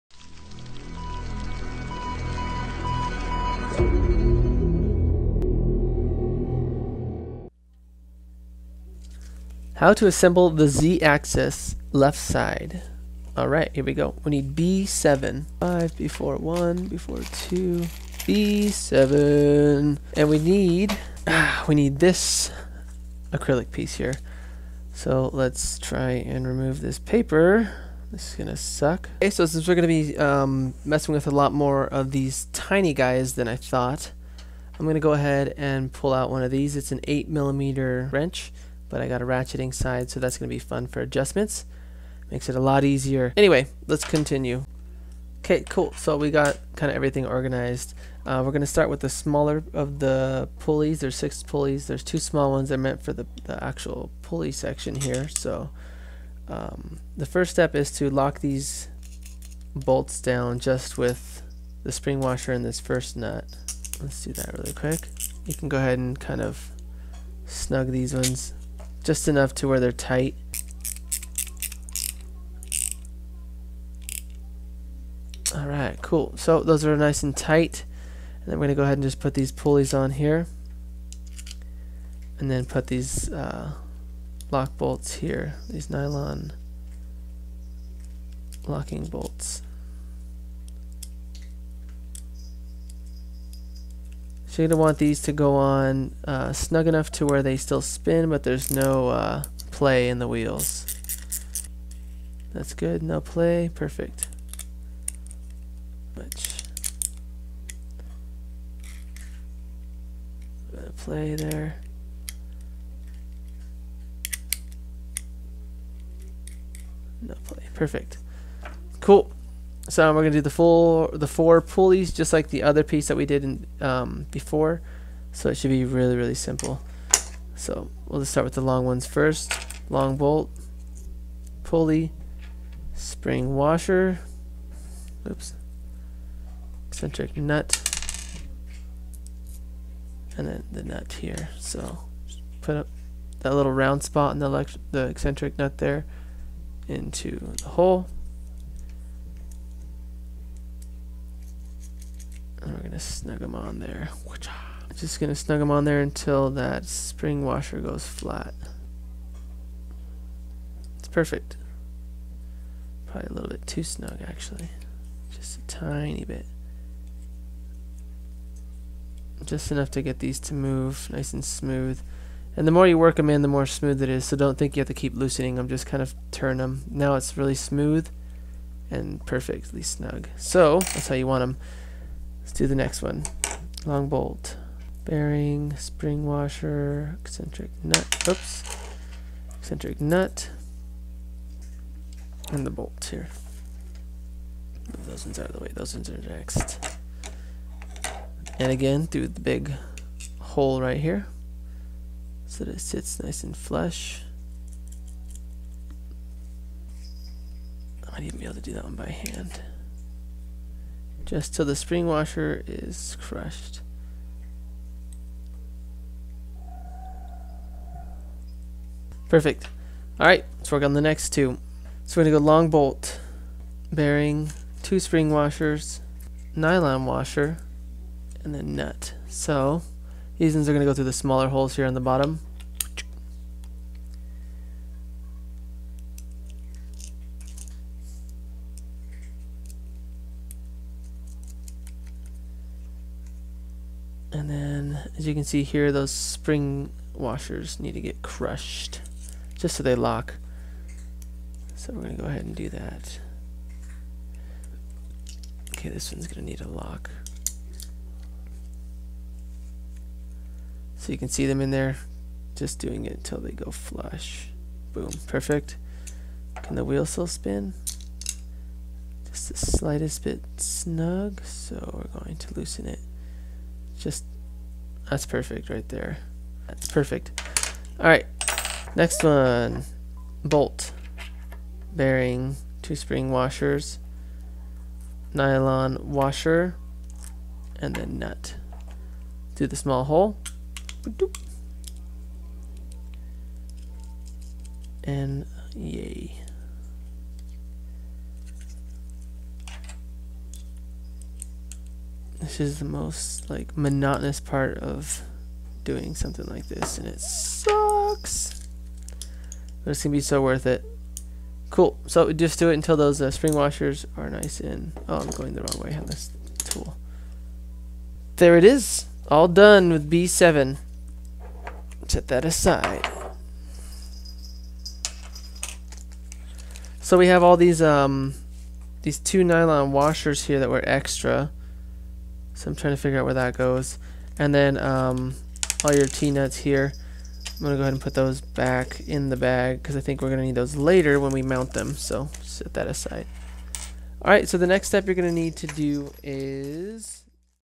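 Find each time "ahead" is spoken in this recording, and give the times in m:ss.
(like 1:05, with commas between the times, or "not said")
0:35, 1:05, 1:18, 4:12, 5:37.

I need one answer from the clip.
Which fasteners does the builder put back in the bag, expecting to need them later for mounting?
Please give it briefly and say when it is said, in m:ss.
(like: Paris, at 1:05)
T-nuts, at 5:36.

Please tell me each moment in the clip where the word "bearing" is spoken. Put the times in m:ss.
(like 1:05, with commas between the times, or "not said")
3:05, 3:43, 4:41.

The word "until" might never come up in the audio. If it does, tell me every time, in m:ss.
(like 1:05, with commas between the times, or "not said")
2:36, 4:23, 5:12.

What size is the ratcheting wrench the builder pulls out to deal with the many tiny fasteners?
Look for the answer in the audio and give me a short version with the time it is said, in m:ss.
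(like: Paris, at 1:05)
8 millimeter, at 0:37.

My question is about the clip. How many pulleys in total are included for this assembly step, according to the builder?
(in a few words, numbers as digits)
6.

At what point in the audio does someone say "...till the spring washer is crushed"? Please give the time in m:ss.
3:31.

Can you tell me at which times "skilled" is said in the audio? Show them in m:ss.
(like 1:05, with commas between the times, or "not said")
not said.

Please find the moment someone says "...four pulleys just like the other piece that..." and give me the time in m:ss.
2:01.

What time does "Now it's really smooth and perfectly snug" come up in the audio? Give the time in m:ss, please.
2:56.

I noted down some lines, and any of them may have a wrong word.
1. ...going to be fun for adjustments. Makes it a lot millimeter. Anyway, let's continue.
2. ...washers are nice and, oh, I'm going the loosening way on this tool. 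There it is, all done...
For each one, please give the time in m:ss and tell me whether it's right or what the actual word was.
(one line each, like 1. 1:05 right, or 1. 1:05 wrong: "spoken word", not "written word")
1. 0:40 wrong: "easier", not "millimeter"
2. 5:13 wrong: "wrong", not "loosening".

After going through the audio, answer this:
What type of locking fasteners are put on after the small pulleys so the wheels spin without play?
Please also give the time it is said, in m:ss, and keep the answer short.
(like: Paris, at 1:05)
nylon locking bolts, at 1:25.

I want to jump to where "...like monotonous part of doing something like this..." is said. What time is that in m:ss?
5:03.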